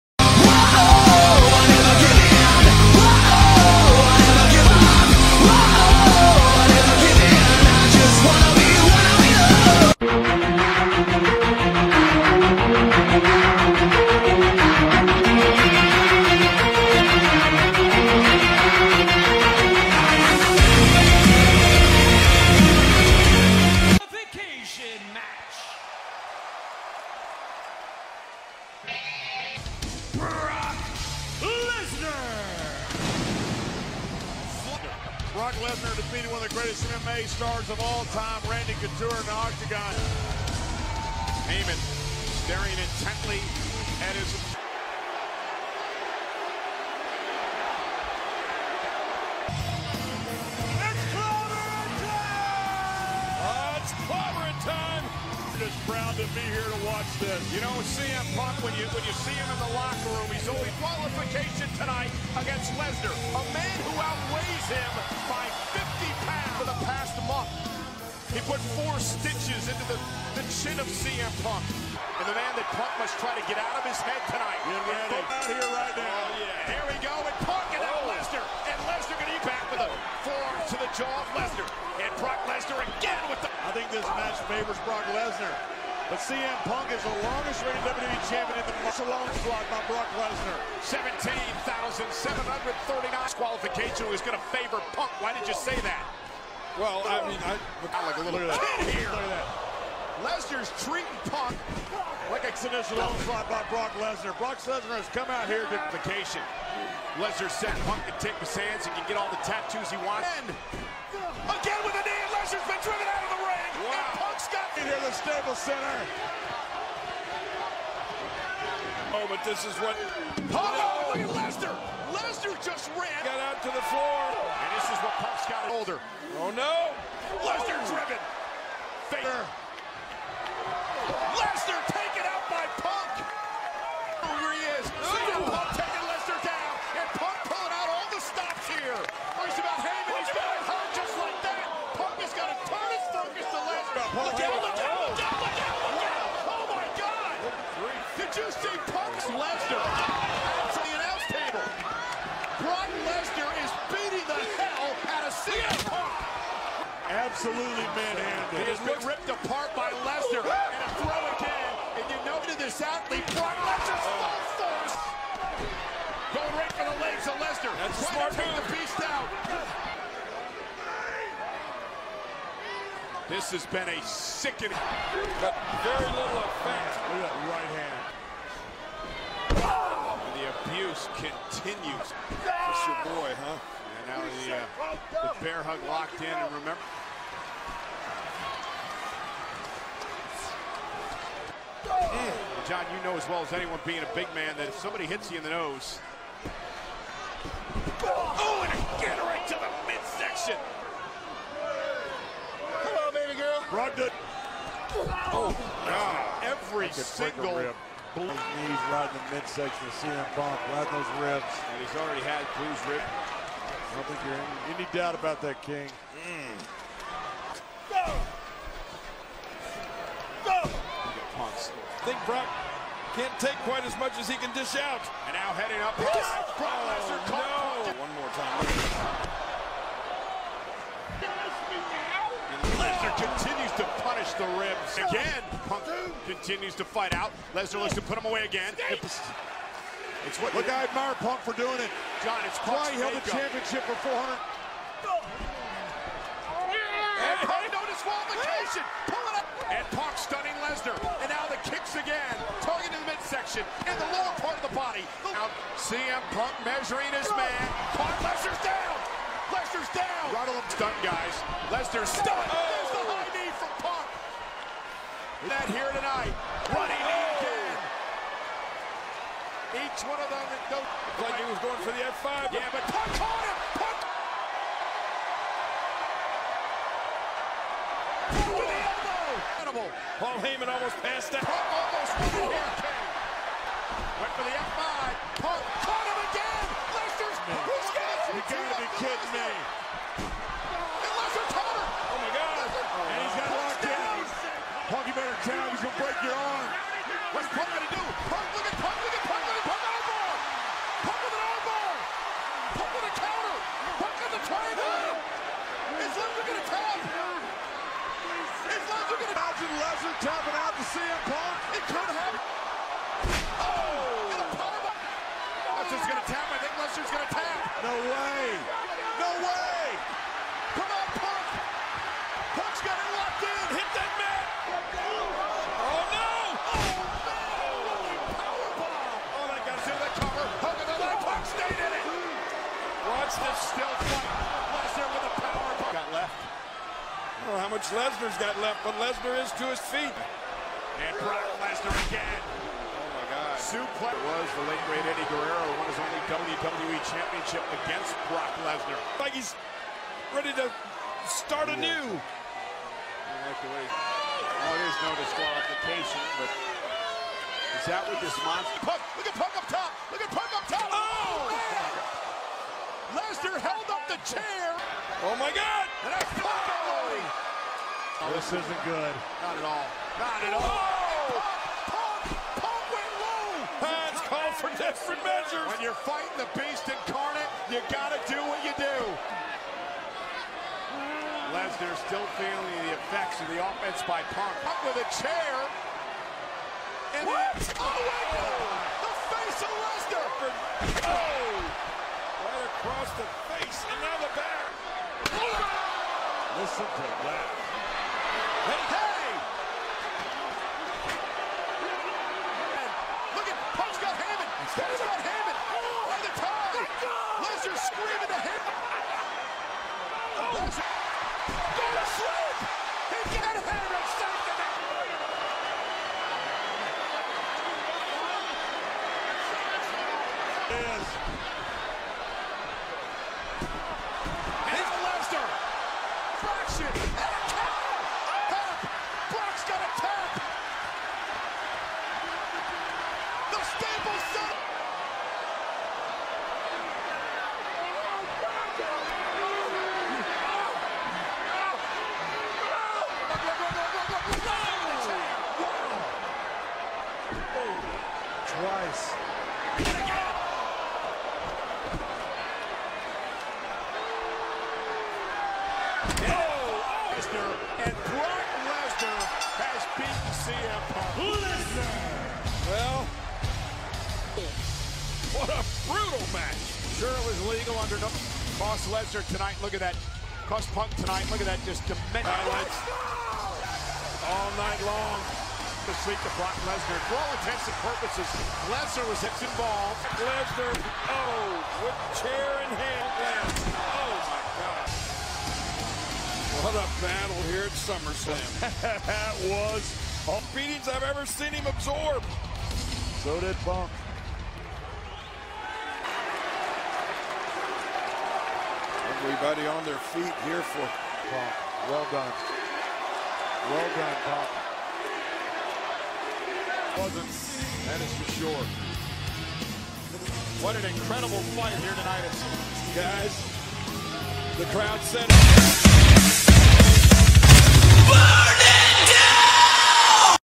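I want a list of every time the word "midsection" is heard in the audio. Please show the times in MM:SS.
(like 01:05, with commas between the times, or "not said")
03:19, 03:29, 04:13.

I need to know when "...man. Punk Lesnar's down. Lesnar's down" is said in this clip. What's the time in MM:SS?
04:17.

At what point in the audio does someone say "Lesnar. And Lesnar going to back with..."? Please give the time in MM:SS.
01:18.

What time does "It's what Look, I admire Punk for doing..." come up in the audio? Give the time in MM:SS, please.
03:58.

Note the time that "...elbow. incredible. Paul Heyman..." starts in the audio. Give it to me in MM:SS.
04:38.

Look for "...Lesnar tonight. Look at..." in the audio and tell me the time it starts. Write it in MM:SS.
07:48.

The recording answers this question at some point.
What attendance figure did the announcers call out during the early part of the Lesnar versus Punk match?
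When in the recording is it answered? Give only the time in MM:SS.
01:31.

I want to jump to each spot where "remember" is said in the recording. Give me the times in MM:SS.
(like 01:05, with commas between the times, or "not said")
03:06.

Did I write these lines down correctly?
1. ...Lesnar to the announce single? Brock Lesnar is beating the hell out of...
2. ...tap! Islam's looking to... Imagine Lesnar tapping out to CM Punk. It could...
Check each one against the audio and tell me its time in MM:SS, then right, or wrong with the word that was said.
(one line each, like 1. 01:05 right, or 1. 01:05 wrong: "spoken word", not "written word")
1. 02:29 wrong: "table", not "single"
2. 05:06 right.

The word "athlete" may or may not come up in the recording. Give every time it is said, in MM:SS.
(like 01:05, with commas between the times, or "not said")
02:42.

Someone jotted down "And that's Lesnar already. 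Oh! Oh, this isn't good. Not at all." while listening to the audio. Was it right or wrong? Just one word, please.
wrong.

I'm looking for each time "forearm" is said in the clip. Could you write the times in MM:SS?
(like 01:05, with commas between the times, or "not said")
01:20.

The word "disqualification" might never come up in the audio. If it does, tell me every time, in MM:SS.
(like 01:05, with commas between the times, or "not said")
04:08, 05:55.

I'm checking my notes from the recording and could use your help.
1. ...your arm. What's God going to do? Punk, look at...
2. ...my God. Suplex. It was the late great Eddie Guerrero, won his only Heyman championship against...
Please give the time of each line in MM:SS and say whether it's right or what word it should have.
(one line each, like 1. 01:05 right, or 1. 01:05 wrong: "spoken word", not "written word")
1. 04:56 wrong: "Punk", not "God"
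2. 05:43 wrong: "WWE", not "Heyman".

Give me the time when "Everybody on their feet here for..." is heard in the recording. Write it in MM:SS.
08:19.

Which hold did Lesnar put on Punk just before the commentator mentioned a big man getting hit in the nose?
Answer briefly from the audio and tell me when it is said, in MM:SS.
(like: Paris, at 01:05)
bear hug, at 03:05.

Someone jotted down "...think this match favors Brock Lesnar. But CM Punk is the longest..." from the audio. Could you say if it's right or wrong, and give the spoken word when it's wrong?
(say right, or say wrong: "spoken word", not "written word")
right.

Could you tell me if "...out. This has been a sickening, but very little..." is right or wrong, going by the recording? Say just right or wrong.
right.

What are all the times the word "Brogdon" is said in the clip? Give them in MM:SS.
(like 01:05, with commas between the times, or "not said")
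03:23.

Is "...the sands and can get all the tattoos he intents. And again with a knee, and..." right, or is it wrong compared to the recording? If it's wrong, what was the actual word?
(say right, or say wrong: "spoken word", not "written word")
wrong: "wants", not "intents".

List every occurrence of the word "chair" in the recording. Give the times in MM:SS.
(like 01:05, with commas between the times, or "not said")
06:04, 06:25, 08:02.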